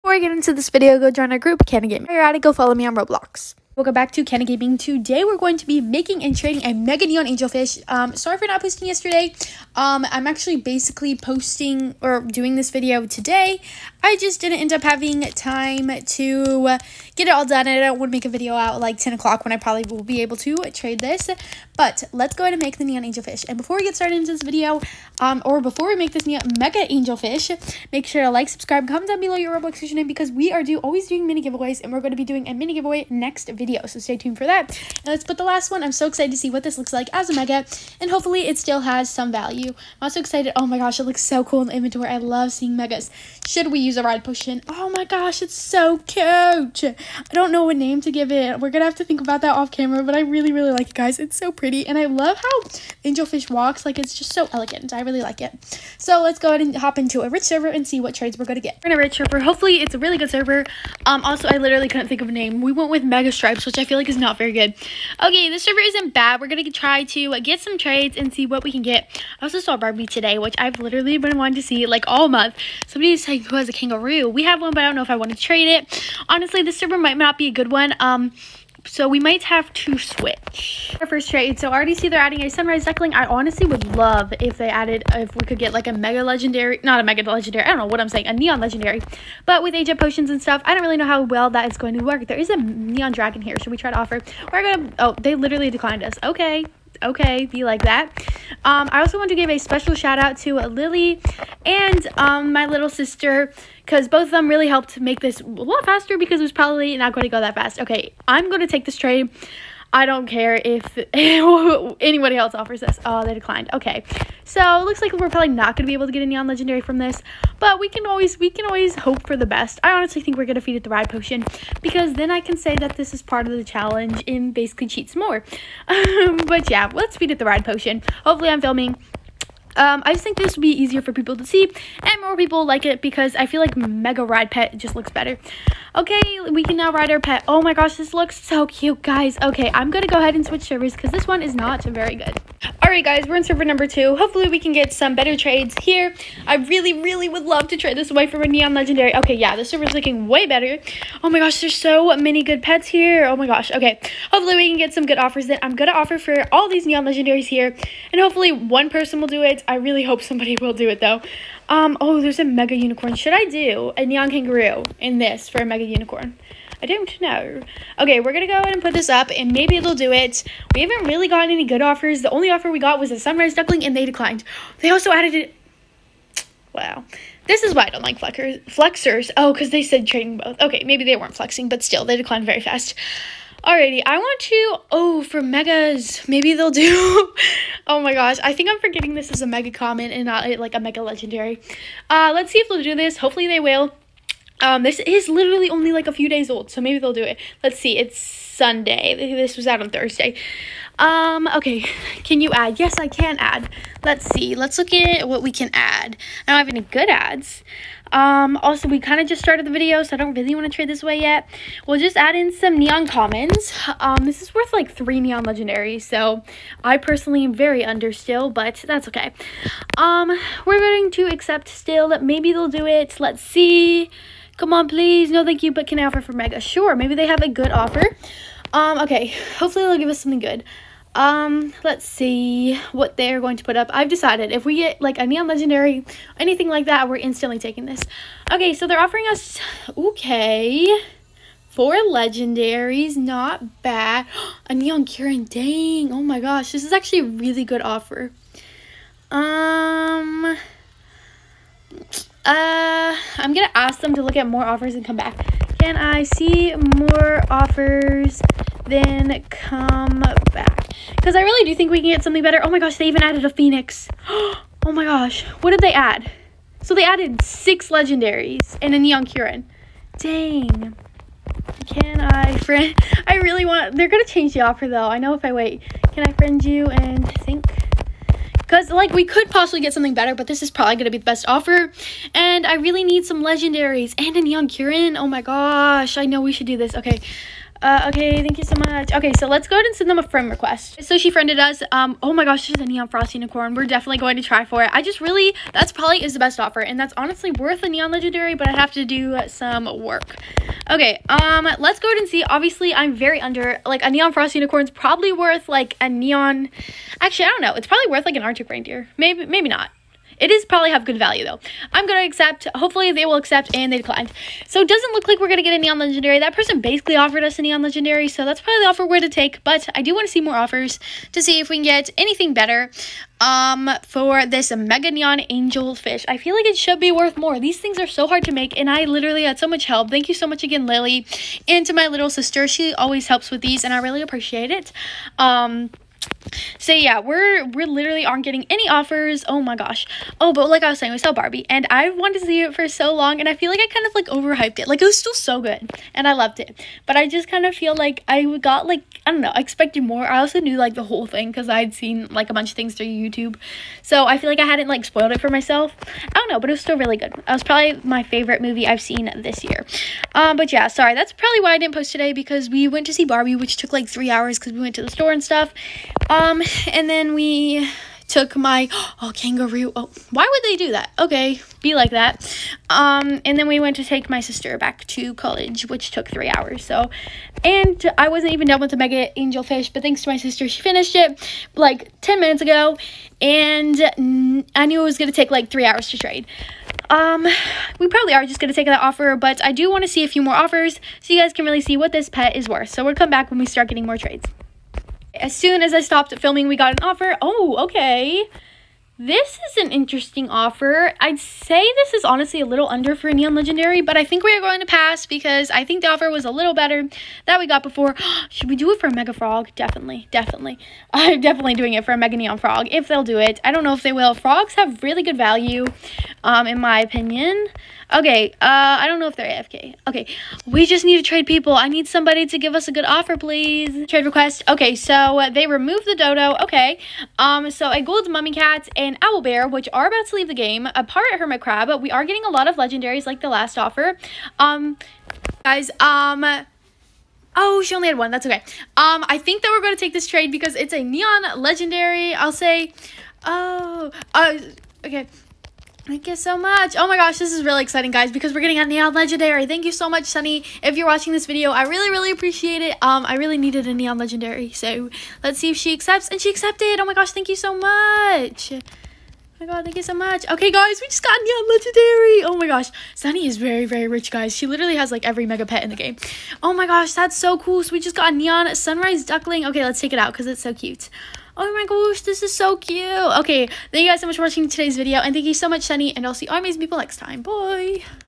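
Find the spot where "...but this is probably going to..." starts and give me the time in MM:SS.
04:40.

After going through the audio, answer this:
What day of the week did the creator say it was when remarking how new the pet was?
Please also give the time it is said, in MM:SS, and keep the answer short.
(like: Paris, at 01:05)
Sunday, at 03:18.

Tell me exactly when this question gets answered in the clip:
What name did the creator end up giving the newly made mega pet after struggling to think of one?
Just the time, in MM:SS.
01:03.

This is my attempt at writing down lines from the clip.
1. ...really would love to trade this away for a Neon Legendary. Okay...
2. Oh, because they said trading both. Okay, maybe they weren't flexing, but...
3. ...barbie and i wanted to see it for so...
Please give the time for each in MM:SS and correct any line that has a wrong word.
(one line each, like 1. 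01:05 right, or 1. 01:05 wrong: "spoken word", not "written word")
1. 02:26 right
2. 02:59 right
3. 05:41 right.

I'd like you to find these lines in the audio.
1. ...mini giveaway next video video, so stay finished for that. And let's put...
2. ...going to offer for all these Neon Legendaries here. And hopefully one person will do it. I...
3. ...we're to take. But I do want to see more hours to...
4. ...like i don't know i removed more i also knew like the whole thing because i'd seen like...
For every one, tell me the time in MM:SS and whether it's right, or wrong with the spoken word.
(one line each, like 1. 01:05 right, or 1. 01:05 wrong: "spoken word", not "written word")
1. 00:32 wrong: "tuned", not "finished"
2. 02:35 right
3. 05:19 wrong: "offers", not "hours"
4. 05:48 wrong: "expected", not "removed".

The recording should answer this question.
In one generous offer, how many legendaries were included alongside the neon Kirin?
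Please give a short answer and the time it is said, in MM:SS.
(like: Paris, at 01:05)
6, at 04:27.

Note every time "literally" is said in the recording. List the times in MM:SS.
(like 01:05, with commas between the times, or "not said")
01:01, 01:10, 01:35, 03:15, 05:29, 05:37, 07:44.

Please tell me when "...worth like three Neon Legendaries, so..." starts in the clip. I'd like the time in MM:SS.
03:34.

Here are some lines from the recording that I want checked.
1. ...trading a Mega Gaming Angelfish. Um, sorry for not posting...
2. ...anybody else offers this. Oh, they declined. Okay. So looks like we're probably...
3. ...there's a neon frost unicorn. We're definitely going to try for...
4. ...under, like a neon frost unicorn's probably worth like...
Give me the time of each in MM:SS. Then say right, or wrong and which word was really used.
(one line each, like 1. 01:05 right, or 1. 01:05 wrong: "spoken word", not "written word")
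1. 00:06 wrong: "Neon", not "Gaming"
2. 01:51 right
3. 04:52 right
4. 05:03 right.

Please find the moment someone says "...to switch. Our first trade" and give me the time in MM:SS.
01:19.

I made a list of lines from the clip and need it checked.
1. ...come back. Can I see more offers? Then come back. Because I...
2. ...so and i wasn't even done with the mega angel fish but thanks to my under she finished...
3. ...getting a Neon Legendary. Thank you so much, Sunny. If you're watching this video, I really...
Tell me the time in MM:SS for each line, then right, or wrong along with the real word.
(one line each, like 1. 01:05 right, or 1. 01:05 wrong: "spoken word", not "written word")
1. 04:15 right
2. 06:16 wrong: "sister", not "under"
3. 07:28 right.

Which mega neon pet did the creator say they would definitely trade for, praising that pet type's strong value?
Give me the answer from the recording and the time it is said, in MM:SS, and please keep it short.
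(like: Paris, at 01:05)
Mega Neon Frog, at 06:52.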